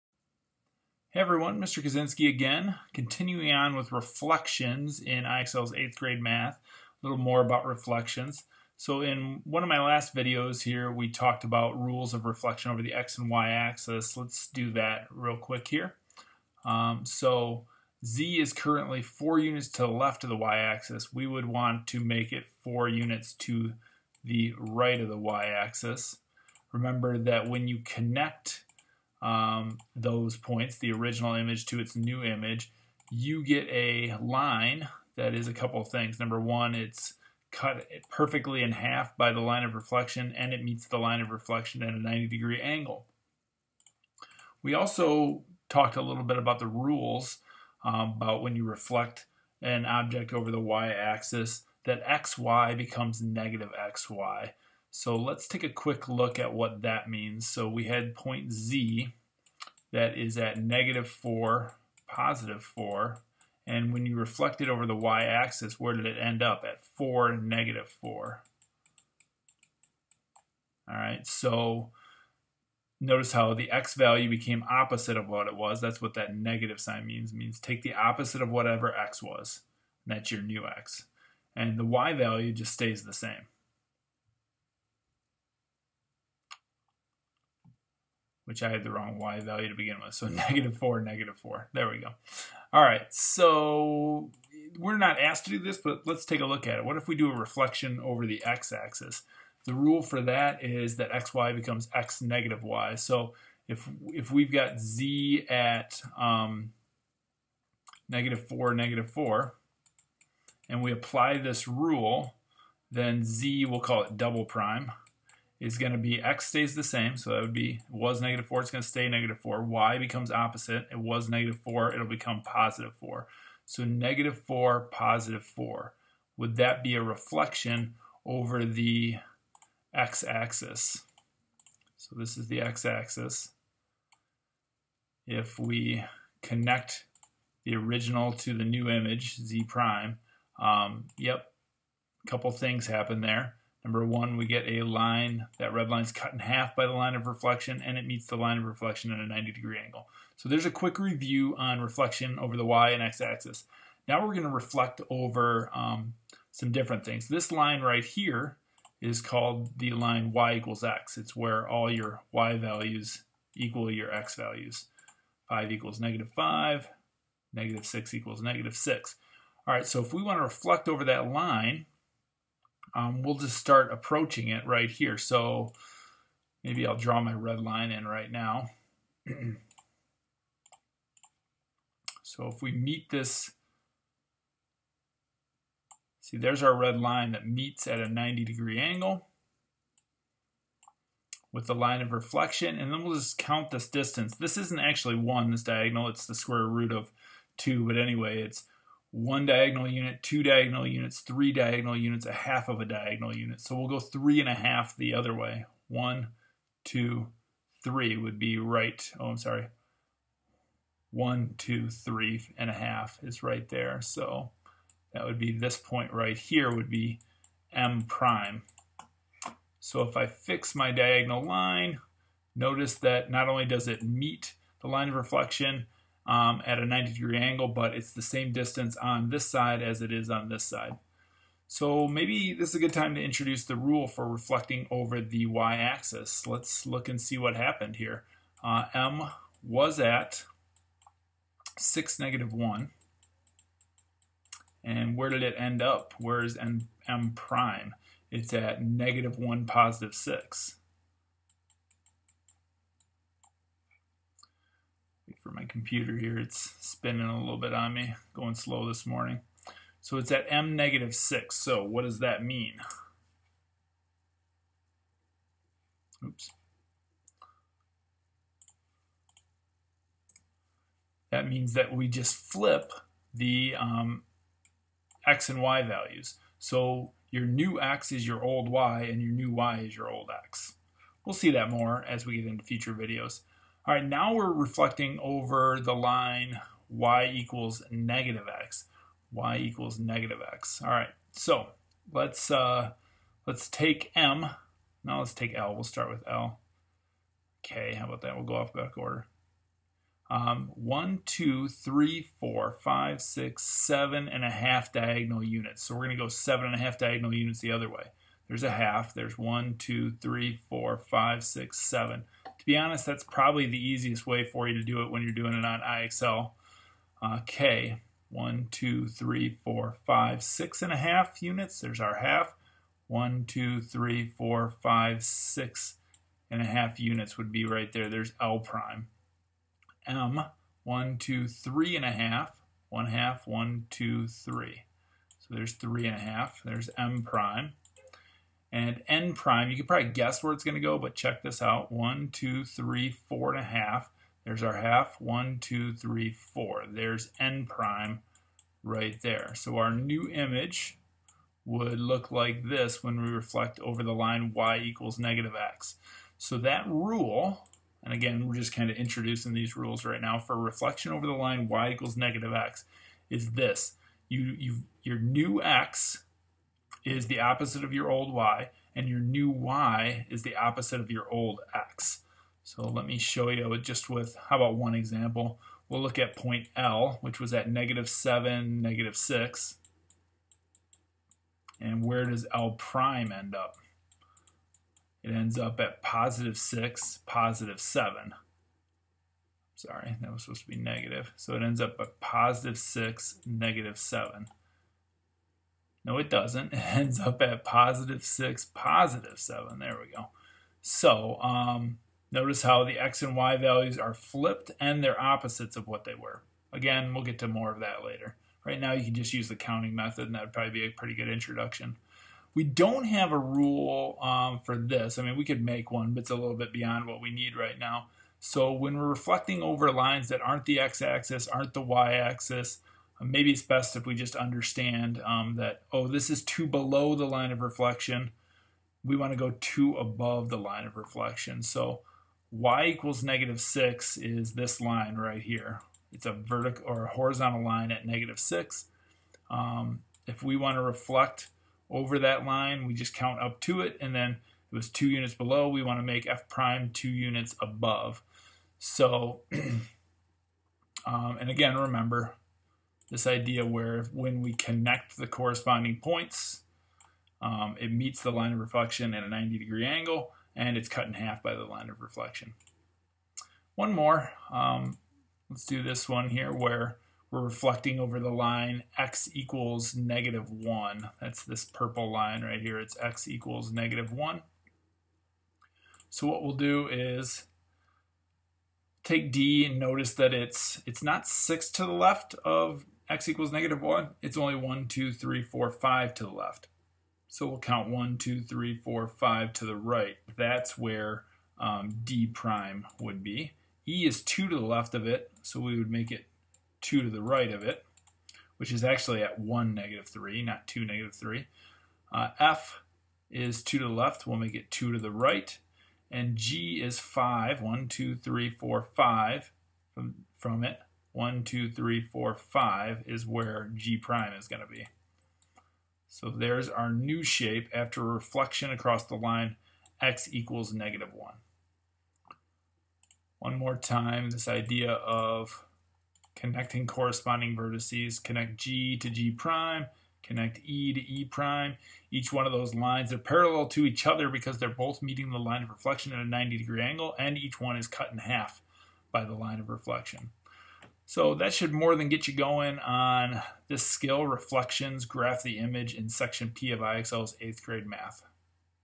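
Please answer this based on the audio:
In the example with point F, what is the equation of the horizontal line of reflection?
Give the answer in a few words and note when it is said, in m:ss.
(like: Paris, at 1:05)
y = -6, at 7:12.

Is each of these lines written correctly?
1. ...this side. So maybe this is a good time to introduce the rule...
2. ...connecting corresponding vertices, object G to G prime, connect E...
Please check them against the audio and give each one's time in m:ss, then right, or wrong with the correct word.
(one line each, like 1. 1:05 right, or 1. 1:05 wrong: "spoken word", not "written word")
1. 3:50 right
2. 8:46 wrong: "connect", not "object".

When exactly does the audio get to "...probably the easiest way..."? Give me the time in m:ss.
5:13.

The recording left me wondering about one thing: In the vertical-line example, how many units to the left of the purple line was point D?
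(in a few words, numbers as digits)
5.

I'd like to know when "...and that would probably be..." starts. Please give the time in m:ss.
6:50.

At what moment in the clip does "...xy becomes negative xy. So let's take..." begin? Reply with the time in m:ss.
0:52.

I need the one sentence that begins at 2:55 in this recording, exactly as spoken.
So maybe I'll draw my red line in right now.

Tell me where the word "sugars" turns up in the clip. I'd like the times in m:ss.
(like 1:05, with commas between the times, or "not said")
not said.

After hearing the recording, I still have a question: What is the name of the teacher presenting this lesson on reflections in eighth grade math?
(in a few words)
Mr. Kuzinski.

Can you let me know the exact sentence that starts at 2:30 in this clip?
So there's a quick review on reflection over the y and x axis.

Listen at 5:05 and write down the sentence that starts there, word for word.
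So we're going to go seven and a half diagonal units the other way.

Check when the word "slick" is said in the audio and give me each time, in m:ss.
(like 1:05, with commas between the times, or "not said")
not said.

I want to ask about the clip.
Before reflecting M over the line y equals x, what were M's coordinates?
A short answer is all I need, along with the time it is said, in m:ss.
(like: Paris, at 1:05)
(6, -1), at 4:01.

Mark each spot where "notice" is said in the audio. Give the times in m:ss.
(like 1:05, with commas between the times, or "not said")
1:12, 3:42, 6:42, 7:59.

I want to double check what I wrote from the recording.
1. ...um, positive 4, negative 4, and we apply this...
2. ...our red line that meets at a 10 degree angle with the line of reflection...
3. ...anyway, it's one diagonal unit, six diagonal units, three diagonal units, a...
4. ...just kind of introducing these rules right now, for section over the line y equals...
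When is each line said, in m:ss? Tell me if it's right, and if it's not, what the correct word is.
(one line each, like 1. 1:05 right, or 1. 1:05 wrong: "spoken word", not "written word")
1. 1:46 wrong: "negative", not "positive"
2. 3:06 wrong: "90", not "10"
3. 3:17 wrong: "two", not "six"
4. 5:58 wrong: "reflection", not "section".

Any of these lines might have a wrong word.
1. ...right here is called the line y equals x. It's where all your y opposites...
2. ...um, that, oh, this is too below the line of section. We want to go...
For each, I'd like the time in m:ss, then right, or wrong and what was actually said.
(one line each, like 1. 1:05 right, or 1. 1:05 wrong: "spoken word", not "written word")
1. 2:37 wrong: "values", not "opposites"
2. 7:05 wrong: "reflection", not "section".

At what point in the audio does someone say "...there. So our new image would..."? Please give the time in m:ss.
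5:49.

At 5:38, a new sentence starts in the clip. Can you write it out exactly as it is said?
And n prime, you can probably guess where it's going to go, but check this out.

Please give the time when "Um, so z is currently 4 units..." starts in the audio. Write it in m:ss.
0:16.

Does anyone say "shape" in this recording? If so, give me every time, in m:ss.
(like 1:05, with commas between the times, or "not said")
8:37.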